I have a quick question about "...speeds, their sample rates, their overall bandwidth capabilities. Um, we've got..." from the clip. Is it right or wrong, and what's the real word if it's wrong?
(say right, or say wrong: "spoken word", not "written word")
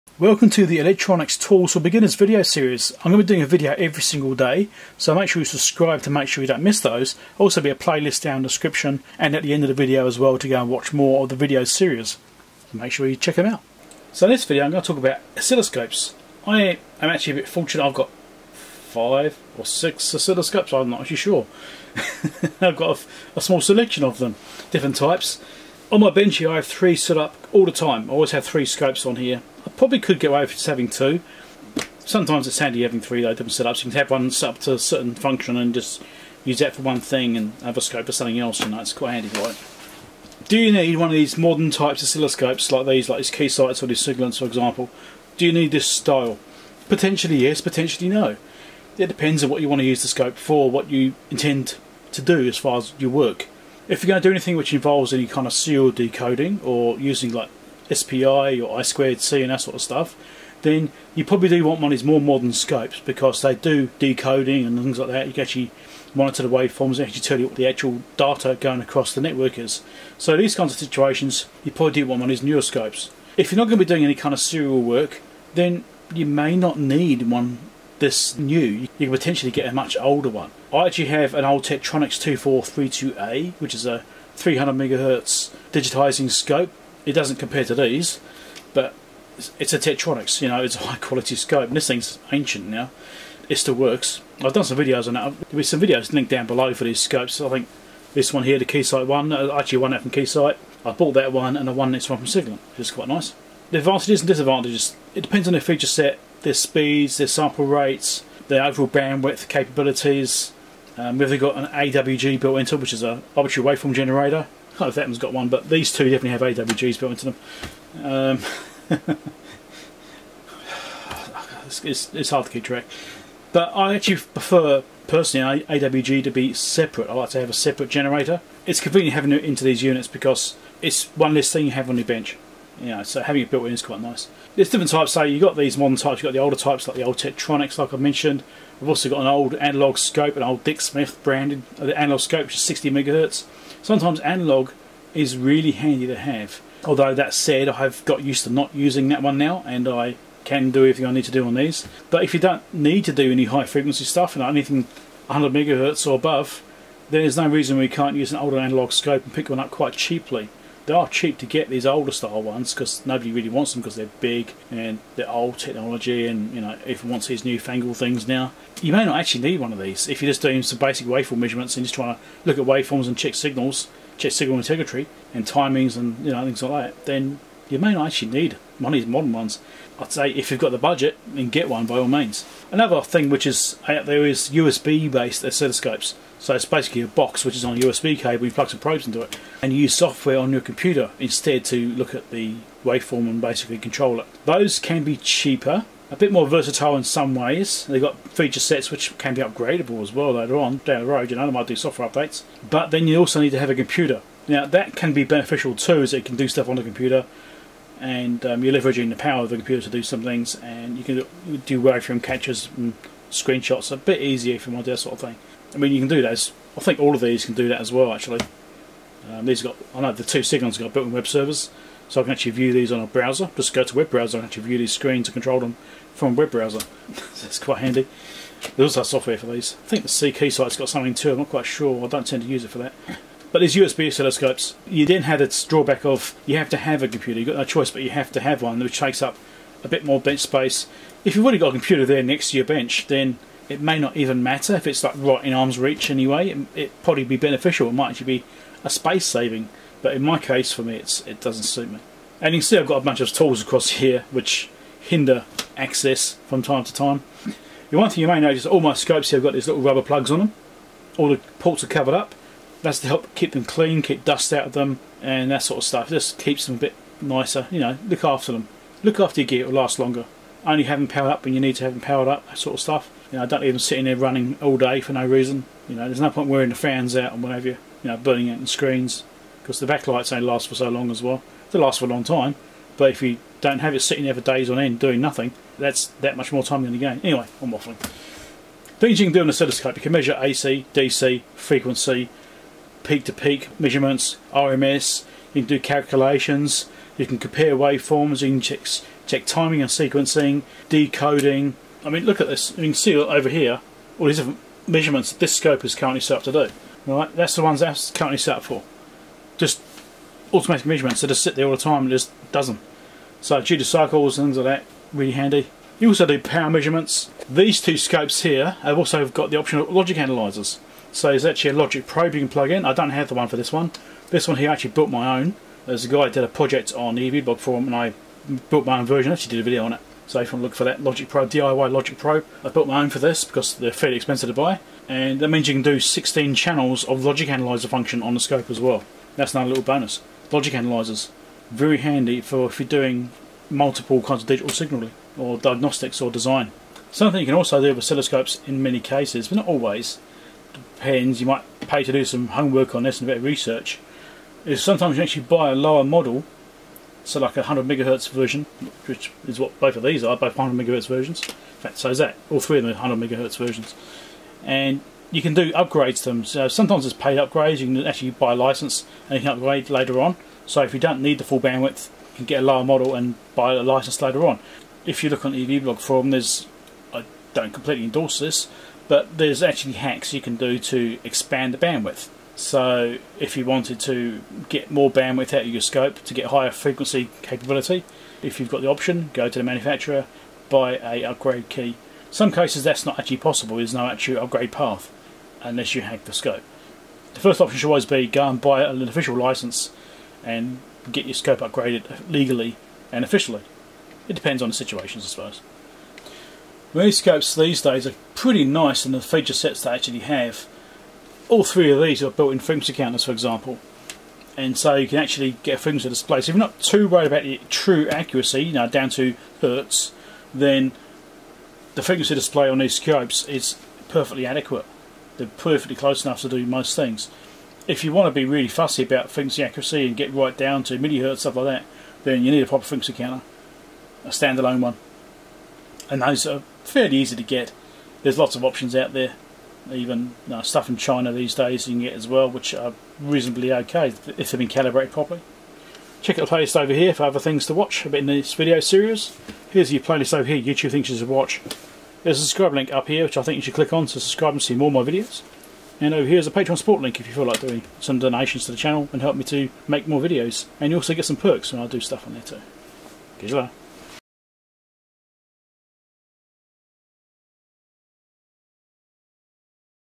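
right.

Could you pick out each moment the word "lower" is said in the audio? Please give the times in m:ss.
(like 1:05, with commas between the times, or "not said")
5:55, 6:12.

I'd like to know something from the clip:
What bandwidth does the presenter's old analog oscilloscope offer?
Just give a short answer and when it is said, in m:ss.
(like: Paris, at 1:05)
60 megahertz, at 2:22.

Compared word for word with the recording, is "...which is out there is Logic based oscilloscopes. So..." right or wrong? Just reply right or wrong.
wrong.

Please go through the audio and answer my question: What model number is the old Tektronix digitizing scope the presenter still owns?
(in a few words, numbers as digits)
2432A.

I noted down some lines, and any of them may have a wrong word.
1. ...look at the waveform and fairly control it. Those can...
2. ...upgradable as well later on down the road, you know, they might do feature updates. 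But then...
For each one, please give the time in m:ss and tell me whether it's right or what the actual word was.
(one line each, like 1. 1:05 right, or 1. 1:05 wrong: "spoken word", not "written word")
1. 3:11 wrong: "basically", not "fairly"
2. 3:19 wrong: "software", not "feature".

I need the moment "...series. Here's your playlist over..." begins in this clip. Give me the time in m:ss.
7:28.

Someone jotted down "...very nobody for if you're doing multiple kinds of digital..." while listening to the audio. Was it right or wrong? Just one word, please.
wrong.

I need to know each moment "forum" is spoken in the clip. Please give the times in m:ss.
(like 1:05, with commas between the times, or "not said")
5:27, 6:15.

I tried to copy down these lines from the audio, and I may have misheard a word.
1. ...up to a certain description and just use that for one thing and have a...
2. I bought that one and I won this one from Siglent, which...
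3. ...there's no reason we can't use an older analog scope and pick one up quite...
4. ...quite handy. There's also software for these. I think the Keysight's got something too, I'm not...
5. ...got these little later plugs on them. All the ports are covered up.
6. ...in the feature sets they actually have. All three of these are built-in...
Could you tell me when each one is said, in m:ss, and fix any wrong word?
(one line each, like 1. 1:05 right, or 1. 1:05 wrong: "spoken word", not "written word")
1. 0:34 wrong: "function", not "description"
2. 1:40 right
3. 2:37 right
4. 3:47 right
5. 4:19 wrong: "rubber", not "later"
6. 6:49 right.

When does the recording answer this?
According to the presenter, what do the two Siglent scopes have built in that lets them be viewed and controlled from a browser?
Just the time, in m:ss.
3:41.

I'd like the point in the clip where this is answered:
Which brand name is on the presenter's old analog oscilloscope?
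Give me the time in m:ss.
2:20.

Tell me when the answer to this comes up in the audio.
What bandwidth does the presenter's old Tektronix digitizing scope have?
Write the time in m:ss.
1:24.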